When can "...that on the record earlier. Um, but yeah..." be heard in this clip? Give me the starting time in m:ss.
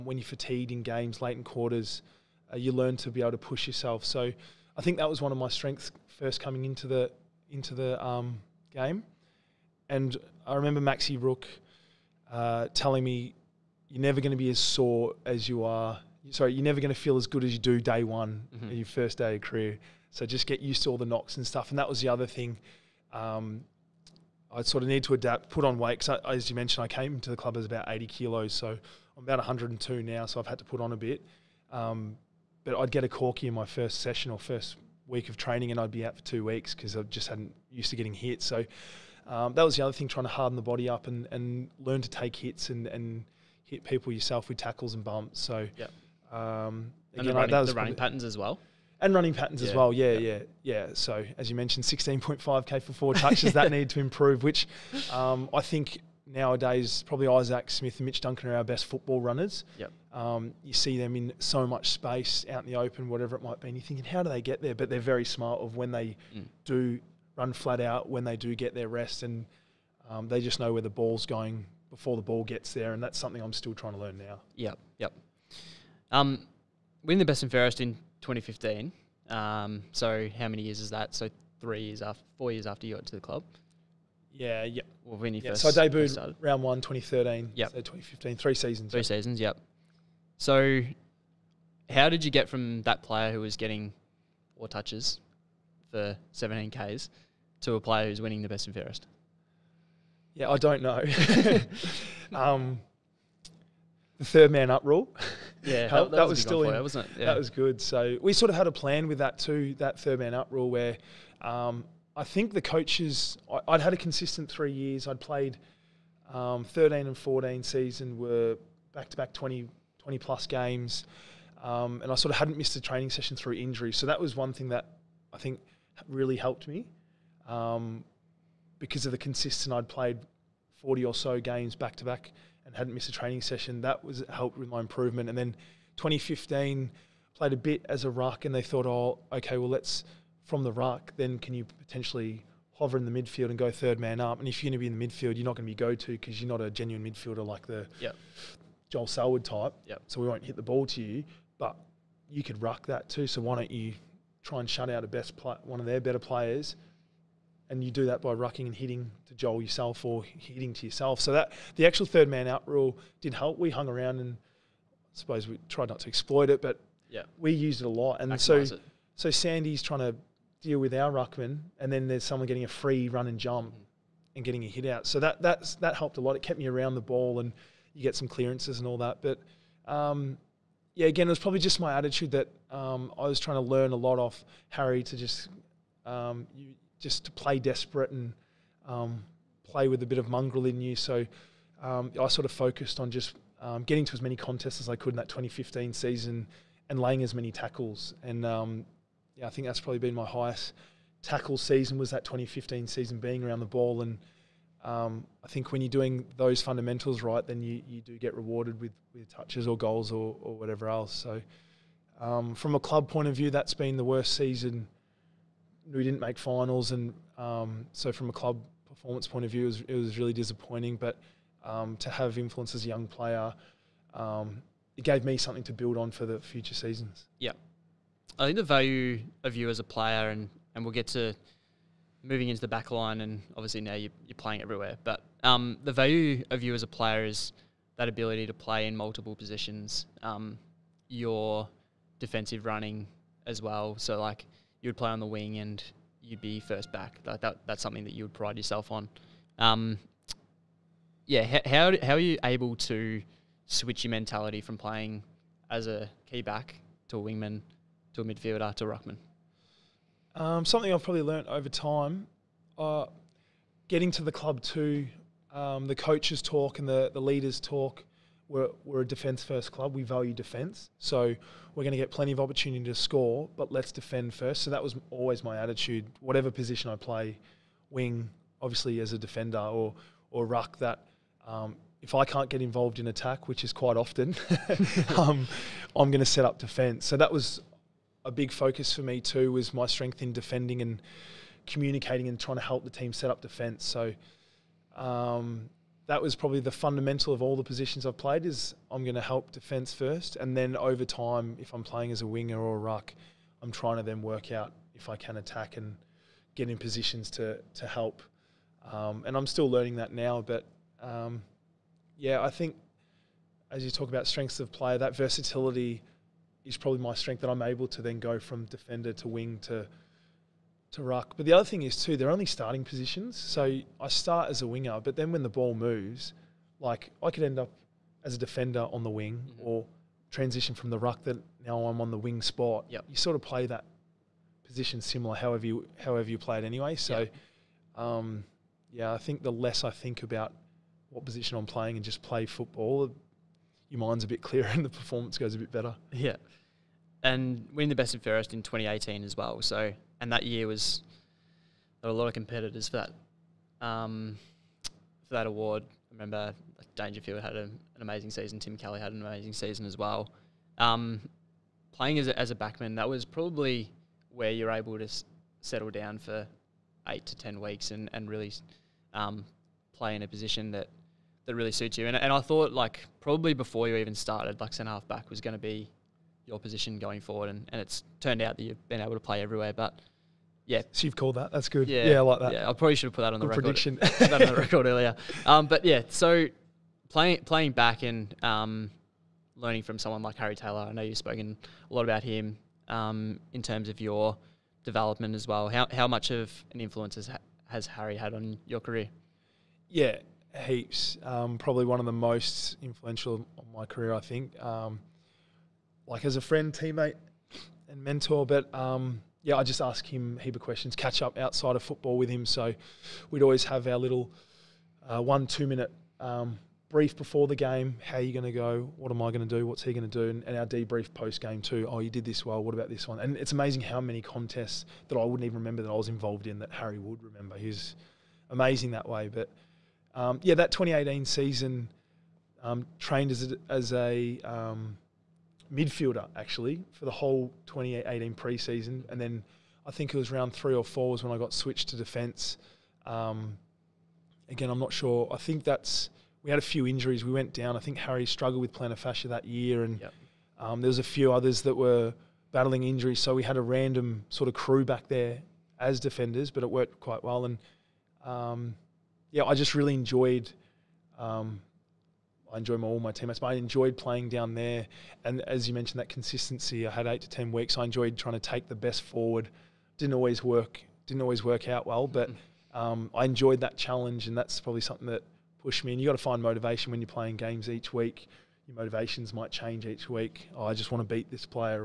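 6:24.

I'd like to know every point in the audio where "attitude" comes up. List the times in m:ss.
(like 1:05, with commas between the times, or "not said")
3:01, 4:35.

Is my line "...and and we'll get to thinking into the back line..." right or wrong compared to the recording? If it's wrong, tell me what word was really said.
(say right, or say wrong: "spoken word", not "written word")
wrong: "moving", not "thinking".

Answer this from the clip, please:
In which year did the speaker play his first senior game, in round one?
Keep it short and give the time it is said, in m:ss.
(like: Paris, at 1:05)
2013, at 1:26.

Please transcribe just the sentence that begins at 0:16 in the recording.
Sorry, you're never going to feel as good as you do day one mm-hmm.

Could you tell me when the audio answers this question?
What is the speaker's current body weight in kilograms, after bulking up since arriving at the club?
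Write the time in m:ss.
0:29.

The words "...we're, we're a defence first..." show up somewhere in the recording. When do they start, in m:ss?
4:28.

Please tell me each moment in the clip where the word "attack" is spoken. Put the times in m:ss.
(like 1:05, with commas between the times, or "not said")
4:43, 5:05.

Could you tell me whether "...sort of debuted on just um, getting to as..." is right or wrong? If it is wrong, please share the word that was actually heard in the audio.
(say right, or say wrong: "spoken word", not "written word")
wrong: "focused", not "debuted".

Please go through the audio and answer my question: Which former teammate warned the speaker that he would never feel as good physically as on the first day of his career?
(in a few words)
Maxi Rooke.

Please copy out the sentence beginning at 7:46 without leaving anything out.
I had eight to ten weeks.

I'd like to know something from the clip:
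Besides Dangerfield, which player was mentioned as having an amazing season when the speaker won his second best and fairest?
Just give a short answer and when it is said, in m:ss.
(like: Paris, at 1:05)
Tim Kelly, at 5:58.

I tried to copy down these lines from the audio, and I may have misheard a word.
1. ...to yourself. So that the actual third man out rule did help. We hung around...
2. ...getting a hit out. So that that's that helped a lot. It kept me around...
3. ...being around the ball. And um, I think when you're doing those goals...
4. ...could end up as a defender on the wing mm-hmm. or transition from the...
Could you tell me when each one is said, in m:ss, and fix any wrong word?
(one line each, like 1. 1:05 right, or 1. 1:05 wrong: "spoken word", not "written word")
1. 2:40 right
2. 2:54 right
3. 3:23 wrong: "fundamentals", not "goals"
4. 5:27 right.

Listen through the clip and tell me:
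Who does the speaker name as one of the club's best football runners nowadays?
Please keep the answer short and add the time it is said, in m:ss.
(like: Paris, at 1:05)
Isaac Smith, at 0:57.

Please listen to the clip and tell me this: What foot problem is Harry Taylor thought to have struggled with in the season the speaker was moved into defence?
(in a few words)
Plantar fascia.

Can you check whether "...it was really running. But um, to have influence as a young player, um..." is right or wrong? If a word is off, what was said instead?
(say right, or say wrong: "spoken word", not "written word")
wrong: "disappointing", not "running".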